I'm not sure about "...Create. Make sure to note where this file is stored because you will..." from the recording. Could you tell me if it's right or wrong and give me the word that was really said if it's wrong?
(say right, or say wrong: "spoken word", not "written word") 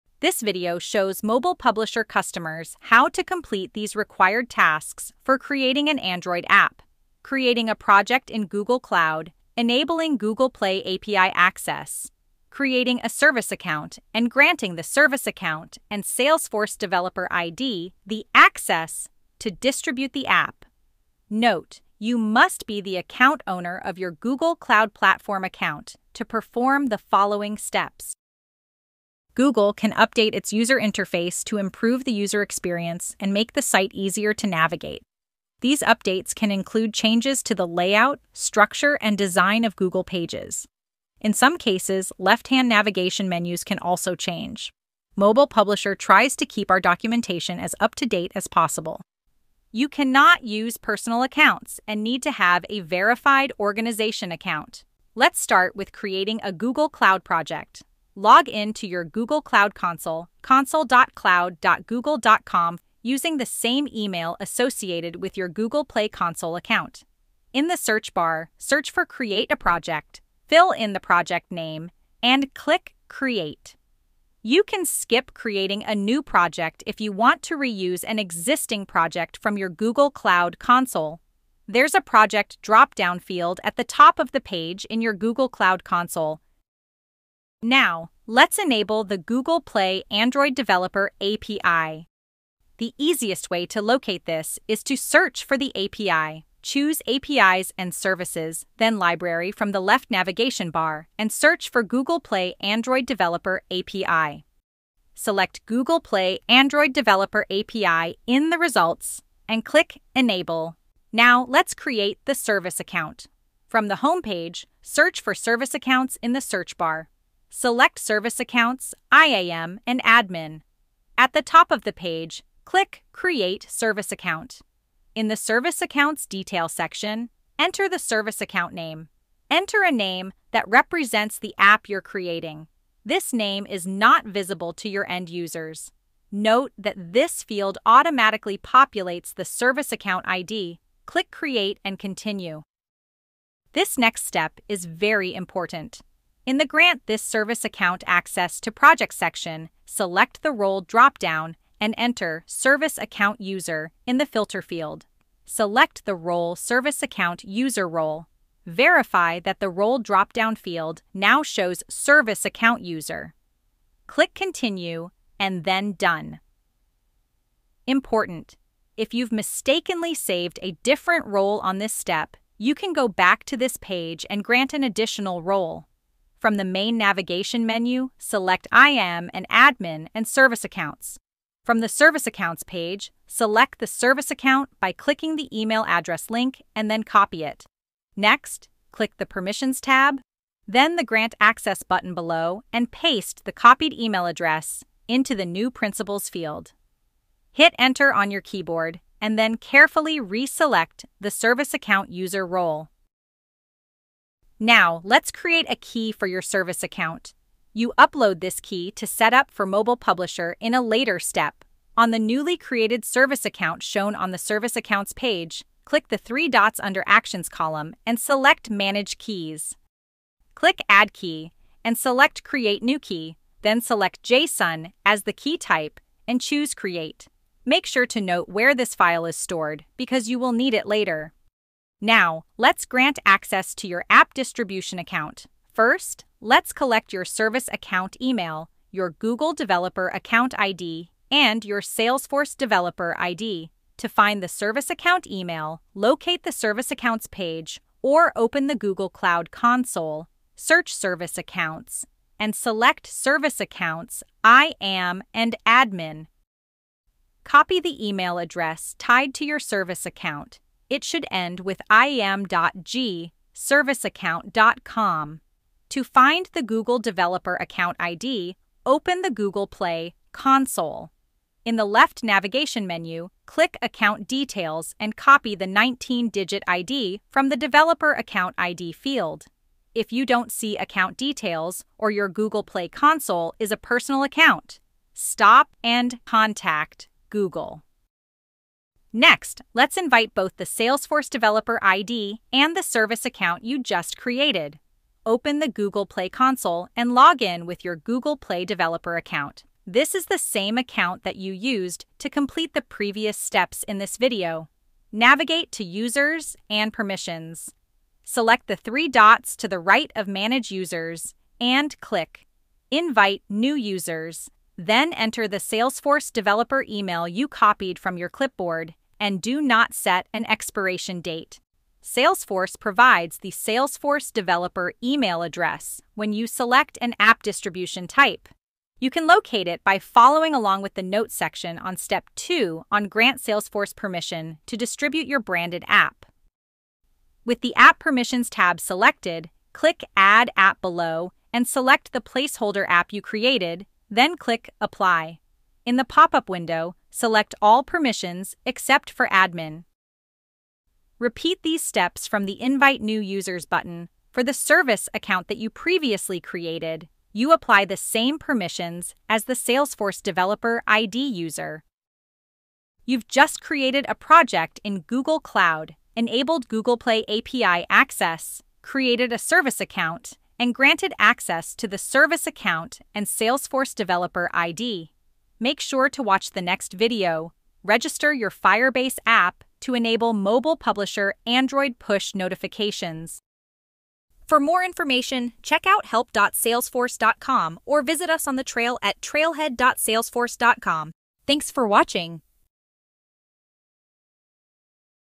right.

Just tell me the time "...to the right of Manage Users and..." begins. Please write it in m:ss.
5:09.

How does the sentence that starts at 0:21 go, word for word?
Note, you must be the account owner of your Google Cloud Platform account to perform the following steps.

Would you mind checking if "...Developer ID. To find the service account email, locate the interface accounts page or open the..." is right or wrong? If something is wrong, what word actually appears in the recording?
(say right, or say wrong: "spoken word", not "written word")
wrong: "service", not "interface".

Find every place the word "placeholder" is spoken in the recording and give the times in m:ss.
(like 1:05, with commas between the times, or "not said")
5:42.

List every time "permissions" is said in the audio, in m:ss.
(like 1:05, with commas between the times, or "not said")
3:09, 5:06, 5:33, 5:37, 5:47, 5:58.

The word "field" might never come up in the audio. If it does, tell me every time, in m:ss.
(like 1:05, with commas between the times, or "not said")
1:23, 2:17, 2:34, 2:40, 3:16, 4:38.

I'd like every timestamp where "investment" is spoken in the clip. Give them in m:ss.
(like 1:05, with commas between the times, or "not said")
not said.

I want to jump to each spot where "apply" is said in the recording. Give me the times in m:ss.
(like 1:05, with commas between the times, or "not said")
5:44, 5:57.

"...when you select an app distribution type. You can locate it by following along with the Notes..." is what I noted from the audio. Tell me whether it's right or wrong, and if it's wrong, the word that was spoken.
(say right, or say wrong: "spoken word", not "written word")
right.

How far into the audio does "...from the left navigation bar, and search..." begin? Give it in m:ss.
1:39.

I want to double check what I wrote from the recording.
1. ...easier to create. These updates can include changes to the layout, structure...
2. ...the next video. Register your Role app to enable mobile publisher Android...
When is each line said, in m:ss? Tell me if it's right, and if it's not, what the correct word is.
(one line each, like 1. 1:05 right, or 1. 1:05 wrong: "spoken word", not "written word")
1. 0:33 wrong: "navigate", not "create"
2. 6:16 wrong: "Firebase", not "Role".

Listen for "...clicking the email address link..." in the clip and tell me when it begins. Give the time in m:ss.
3:04.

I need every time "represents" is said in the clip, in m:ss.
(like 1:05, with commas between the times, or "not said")
2:10.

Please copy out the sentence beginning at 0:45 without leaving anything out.
Mobile Publisher tries to keep our documentation as up to date as possible.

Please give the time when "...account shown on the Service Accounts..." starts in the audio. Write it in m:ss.
3:33.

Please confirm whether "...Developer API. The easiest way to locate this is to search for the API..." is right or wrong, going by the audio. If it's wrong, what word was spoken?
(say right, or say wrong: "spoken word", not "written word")
right.